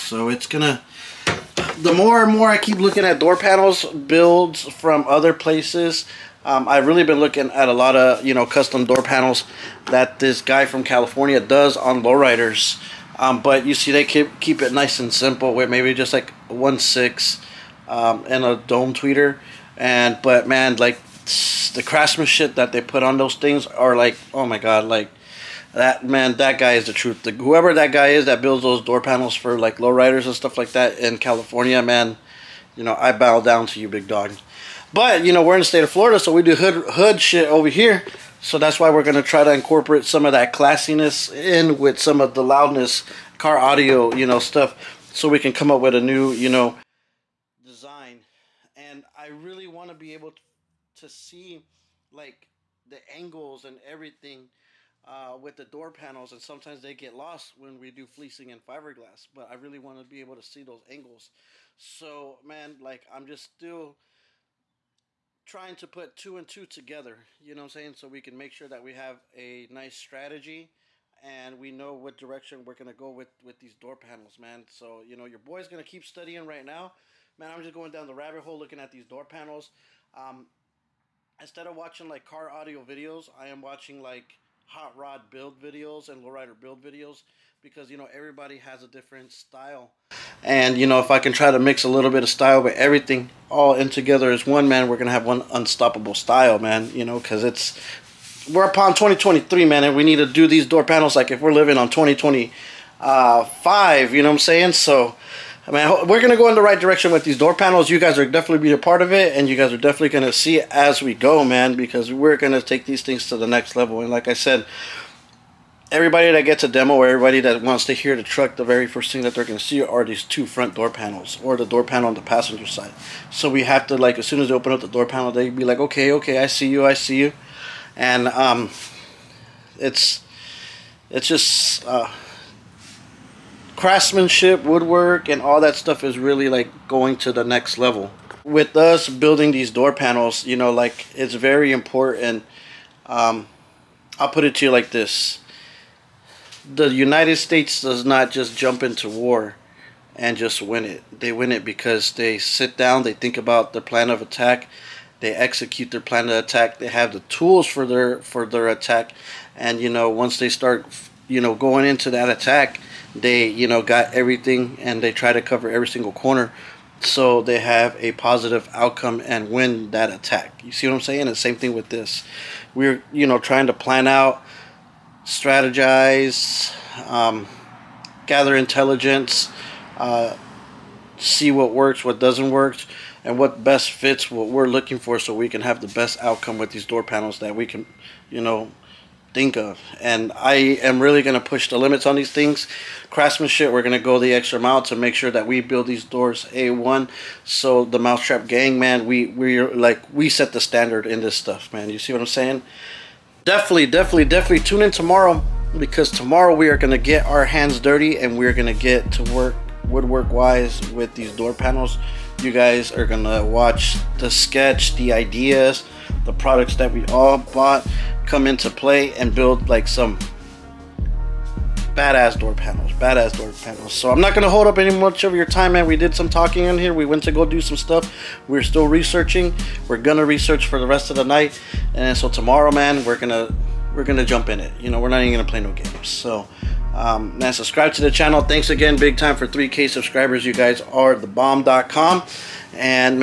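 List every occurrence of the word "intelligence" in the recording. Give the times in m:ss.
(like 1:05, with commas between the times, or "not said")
2:58.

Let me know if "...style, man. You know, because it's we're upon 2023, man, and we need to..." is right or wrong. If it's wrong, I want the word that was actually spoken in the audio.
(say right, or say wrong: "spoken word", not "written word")
right.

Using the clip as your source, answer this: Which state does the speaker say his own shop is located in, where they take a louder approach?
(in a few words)
Florida.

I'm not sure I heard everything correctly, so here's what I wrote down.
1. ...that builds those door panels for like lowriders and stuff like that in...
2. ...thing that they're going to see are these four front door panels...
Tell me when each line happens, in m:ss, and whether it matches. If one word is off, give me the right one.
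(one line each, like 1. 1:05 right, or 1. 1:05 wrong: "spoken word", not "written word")
1. 0:28 right
2. 1:59 wrong: "two", not "four".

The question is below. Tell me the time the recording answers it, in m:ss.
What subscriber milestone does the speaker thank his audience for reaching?
3:59.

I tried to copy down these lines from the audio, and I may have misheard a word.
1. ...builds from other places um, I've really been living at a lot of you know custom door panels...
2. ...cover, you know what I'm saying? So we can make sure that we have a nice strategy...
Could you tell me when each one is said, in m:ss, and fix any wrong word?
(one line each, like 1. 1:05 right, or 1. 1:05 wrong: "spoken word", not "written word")
1. 0:03 wrong: "looking", not "living"
2. 1:06 wrong: "together", not "cover".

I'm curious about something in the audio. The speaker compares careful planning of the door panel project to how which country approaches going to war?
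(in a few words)
United States.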